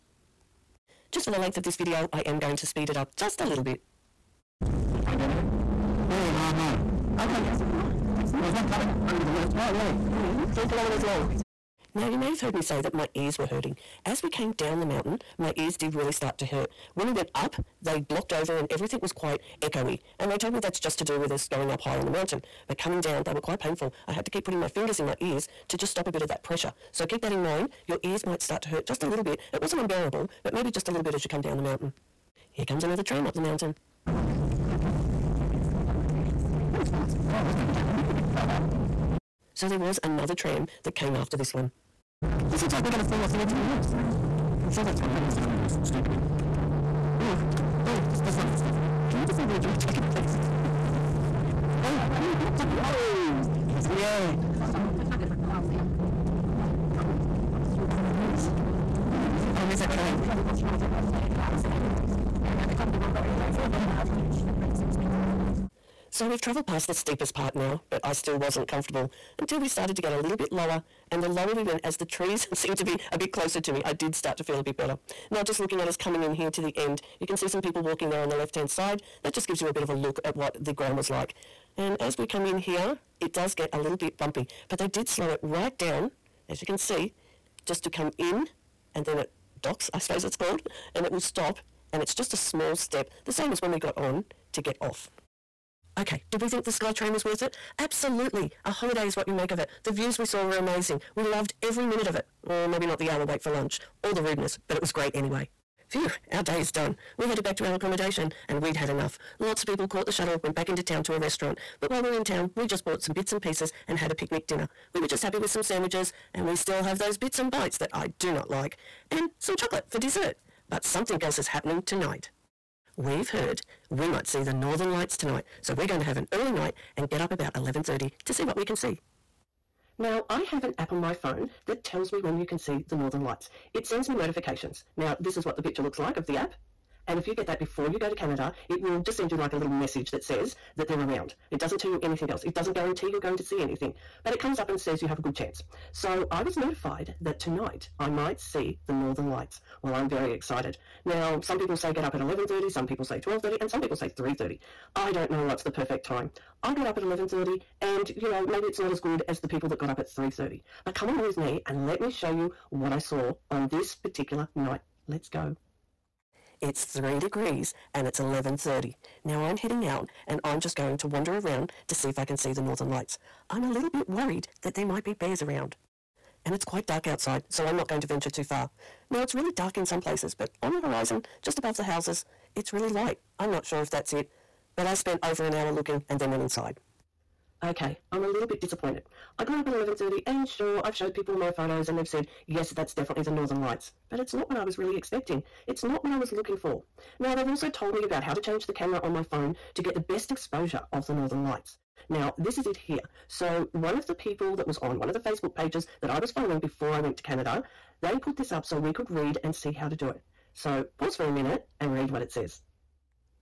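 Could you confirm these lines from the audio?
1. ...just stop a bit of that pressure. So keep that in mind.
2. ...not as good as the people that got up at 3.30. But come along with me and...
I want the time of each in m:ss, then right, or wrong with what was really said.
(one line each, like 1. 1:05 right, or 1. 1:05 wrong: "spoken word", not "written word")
1. 0:25 right
2. 2:38 right.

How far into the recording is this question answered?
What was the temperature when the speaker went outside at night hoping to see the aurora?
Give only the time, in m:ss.
2:46.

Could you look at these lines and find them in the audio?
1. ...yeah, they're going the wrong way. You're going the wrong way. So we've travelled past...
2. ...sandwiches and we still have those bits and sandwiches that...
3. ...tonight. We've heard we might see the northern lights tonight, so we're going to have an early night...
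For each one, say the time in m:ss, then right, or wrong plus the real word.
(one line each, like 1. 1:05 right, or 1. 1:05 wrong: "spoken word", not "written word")
1. 1:02 right
2. 1:55 wrong: "bites", not "sandwiches"
3. 2:01 right.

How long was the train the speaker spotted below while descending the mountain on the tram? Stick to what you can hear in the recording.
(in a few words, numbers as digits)
3 kilometres.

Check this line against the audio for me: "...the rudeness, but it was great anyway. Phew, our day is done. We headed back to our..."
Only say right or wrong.
right.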